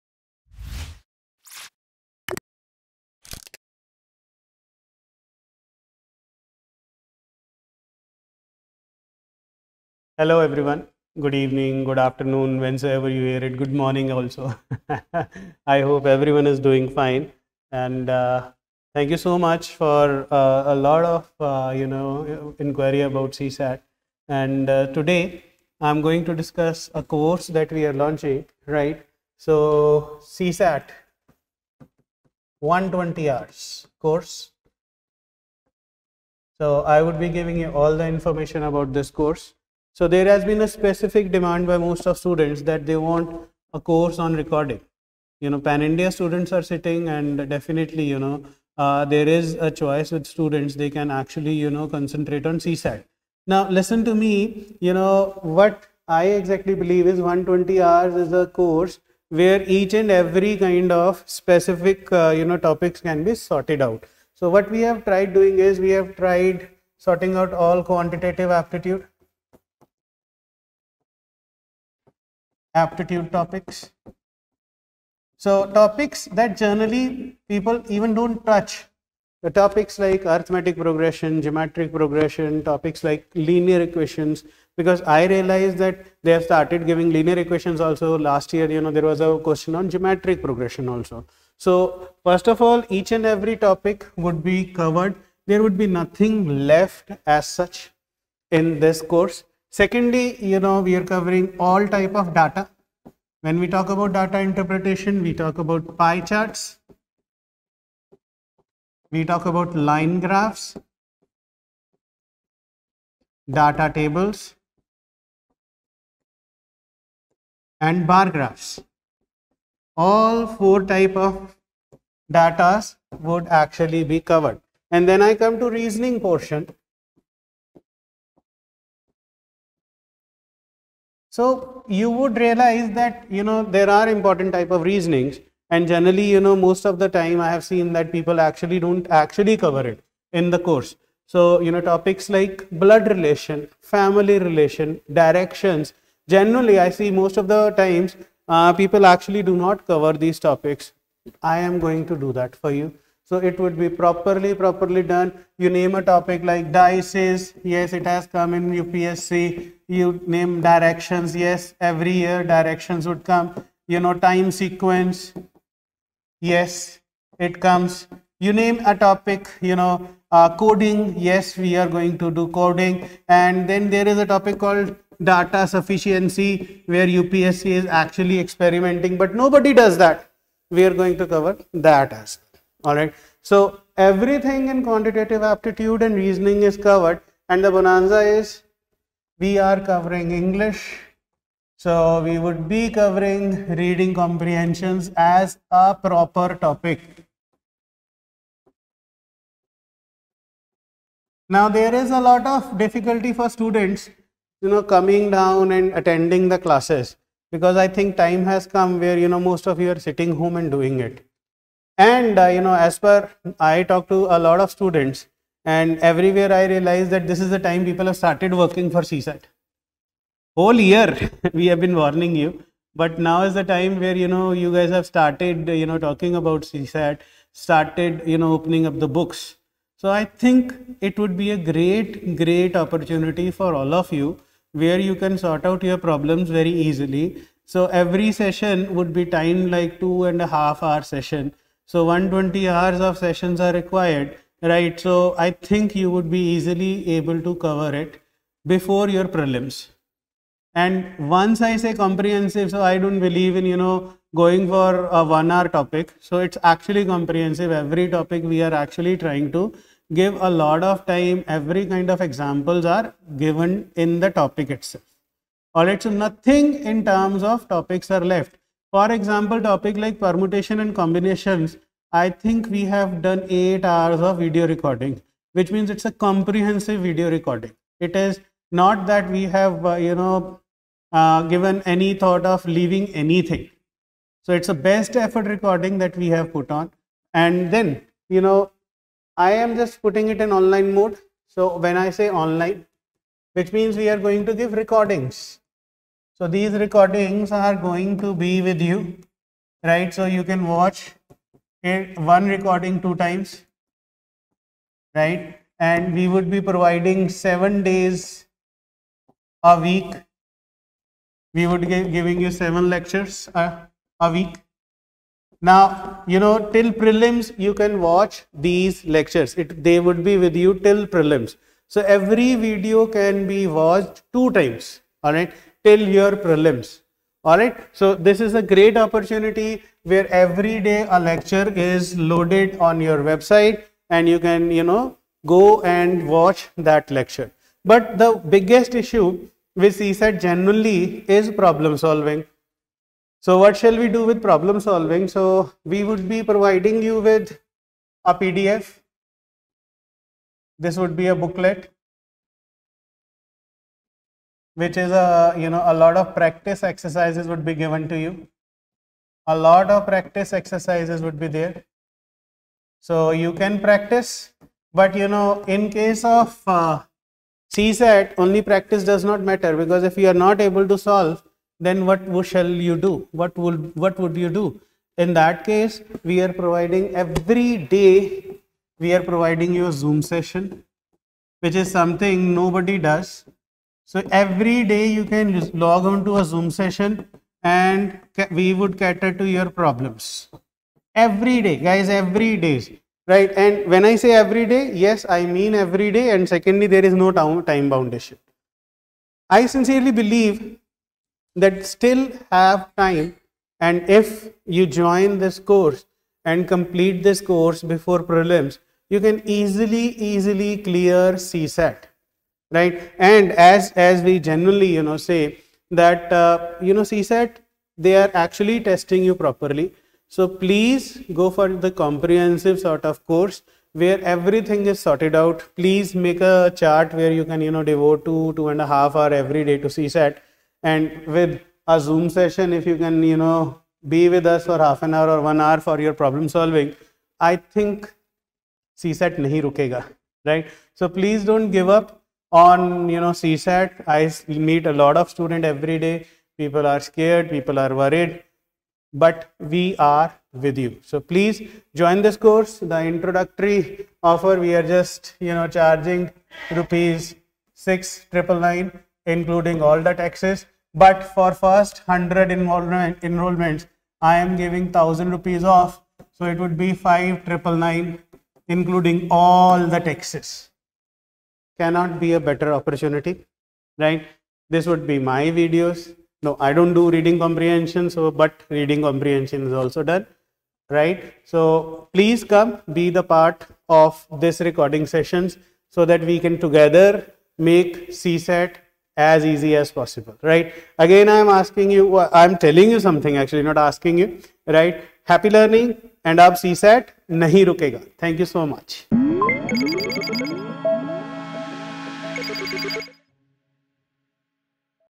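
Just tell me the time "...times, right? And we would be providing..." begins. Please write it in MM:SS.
05:03.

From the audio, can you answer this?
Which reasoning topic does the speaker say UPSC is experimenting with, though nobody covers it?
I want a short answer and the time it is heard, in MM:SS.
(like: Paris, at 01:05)
Data sufficiency, at 02:55.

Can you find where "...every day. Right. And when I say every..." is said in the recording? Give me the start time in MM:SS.
06:32.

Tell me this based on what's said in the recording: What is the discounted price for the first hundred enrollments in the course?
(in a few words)
Rs 5999.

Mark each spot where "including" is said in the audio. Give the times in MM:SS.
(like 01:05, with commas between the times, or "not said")
07:39, 07:48.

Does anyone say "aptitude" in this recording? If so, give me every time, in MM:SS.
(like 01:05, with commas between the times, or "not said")
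01:08, 01:12, 03:05.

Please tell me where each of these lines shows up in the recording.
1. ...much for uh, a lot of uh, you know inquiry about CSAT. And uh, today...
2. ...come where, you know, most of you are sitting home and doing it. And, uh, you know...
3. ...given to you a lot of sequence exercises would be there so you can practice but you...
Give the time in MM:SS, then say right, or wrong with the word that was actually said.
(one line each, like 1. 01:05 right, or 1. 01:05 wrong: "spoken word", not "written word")
1. 00:19 right
2. 03:28 right
3. 05:57 wrong: "practice", not "sequence".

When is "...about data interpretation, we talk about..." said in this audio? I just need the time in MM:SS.
01:43.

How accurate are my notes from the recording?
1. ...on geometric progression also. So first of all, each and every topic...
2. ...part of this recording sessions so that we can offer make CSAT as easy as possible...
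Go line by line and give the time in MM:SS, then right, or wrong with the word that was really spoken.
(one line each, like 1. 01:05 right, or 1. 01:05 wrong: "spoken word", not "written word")
1. 01:29 right
2. 08:03 wrong: "together", not "offer".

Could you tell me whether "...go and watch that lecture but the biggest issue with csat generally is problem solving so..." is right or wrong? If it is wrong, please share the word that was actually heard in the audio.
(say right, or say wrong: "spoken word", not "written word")
right.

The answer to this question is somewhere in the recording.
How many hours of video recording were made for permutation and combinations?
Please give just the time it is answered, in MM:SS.
04:33.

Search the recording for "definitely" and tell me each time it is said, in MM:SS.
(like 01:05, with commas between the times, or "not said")
00:47.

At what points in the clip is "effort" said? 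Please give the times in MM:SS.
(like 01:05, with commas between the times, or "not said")
04:45.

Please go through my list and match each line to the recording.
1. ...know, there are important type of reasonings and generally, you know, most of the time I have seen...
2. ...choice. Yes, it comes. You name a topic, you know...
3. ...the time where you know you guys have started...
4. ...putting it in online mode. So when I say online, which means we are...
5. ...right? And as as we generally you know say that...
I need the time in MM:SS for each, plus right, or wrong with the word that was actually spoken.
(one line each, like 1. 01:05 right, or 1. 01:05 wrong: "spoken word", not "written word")
1. 02:13 right
2. 02:44 wrong: "sequence", not "choice"
3. 03:43 right
4. 04:50 right
5. 06:52 right.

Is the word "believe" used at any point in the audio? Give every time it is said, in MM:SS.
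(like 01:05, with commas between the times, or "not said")
00:56, 04:13, 06:40.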